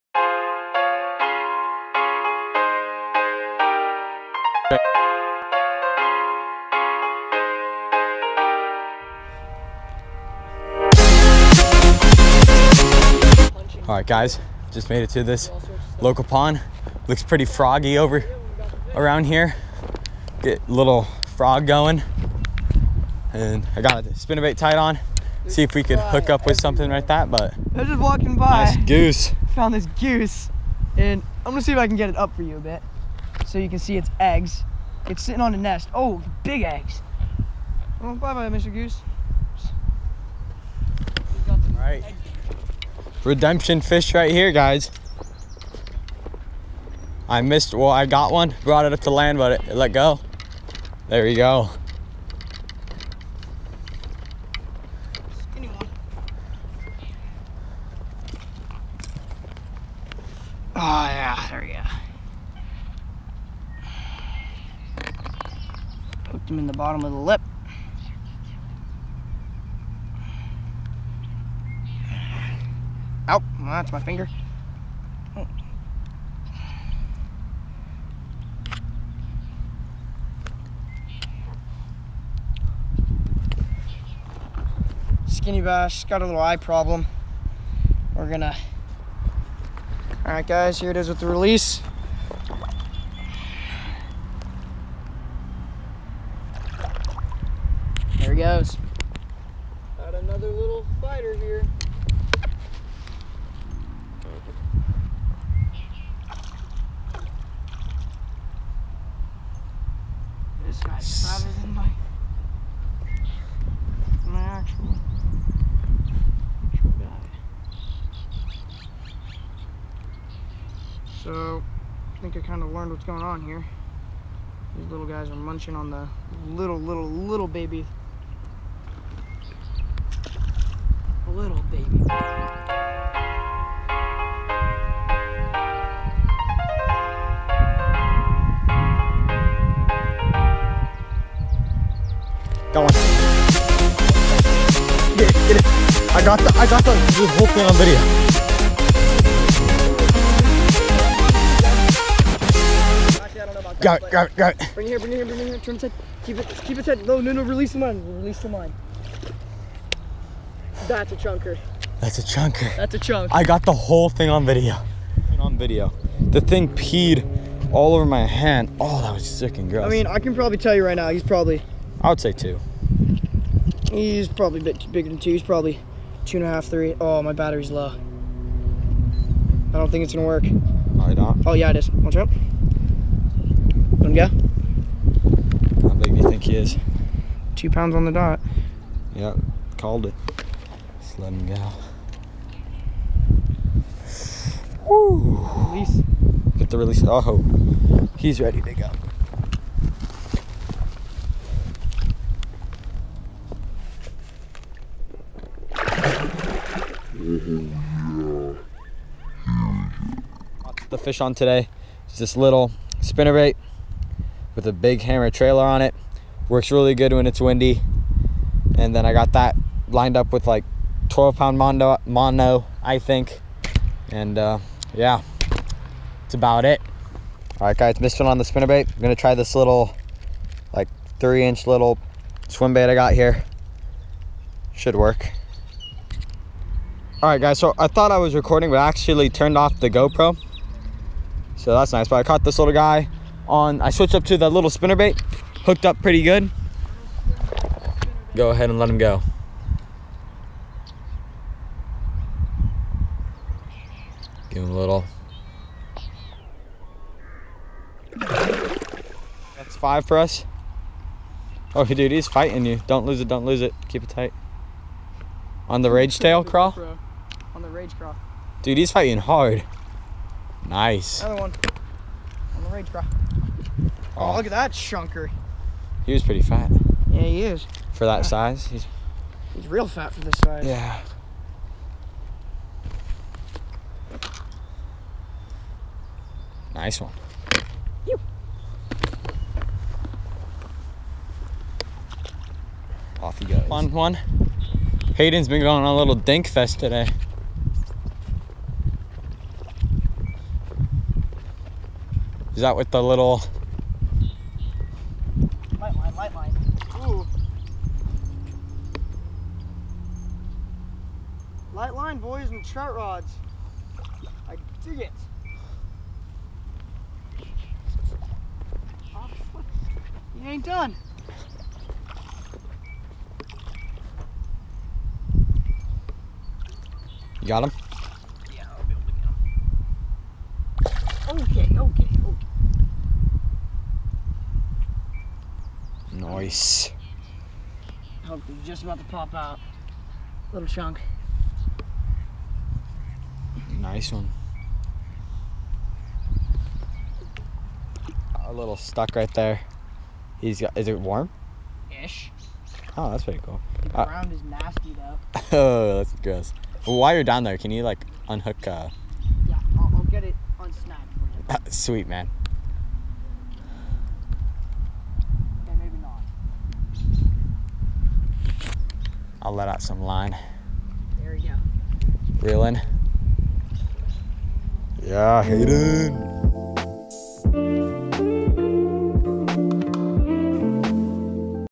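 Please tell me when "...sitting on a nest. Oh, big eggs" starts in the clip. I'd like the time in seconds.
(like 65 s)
35 s.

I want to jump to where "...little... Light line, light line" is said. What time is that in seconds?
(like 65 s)
303 s.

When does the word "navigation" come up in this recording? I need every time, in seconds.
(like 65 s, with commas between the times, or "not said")
not said.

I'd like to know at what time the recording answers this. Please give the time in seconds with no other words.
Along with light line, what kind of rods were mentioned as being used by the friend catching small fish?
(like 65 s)
312 s.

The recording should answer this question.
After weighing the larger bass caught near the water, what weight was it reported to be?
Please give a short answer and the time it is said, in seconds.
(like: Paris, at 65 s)
2 pounds, at 187 s.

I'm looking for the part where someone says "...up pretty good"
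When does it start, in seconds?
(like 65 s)
245 s.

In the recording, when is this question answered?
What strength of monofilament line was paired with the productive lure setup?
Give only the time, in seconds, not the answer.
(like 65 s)
221 s.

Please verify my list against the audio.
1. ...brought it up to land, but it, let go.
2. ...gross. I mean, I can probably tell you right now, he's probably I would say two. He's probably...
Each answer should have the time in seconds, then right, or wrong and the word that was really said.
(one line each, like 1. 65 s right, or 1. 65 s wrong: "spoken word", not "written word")
1. 48 s right
2. 169 s right.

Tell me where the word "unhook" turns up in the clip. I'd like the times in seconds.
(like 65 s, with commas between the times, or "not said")
358 s.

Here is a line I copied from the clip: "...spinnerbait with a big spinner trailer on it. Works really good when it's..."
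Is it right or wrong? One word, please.
wrong.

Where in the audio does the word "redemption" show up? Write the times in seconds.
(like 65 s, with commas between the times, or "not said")
43 s.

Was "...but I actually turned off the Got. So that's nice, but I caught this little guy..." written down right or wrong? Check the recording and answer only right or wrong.
wrong.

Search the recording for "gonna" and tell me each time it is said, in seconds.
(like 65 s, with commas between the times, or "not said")
31 s, 88 s, 180 s, 229 s.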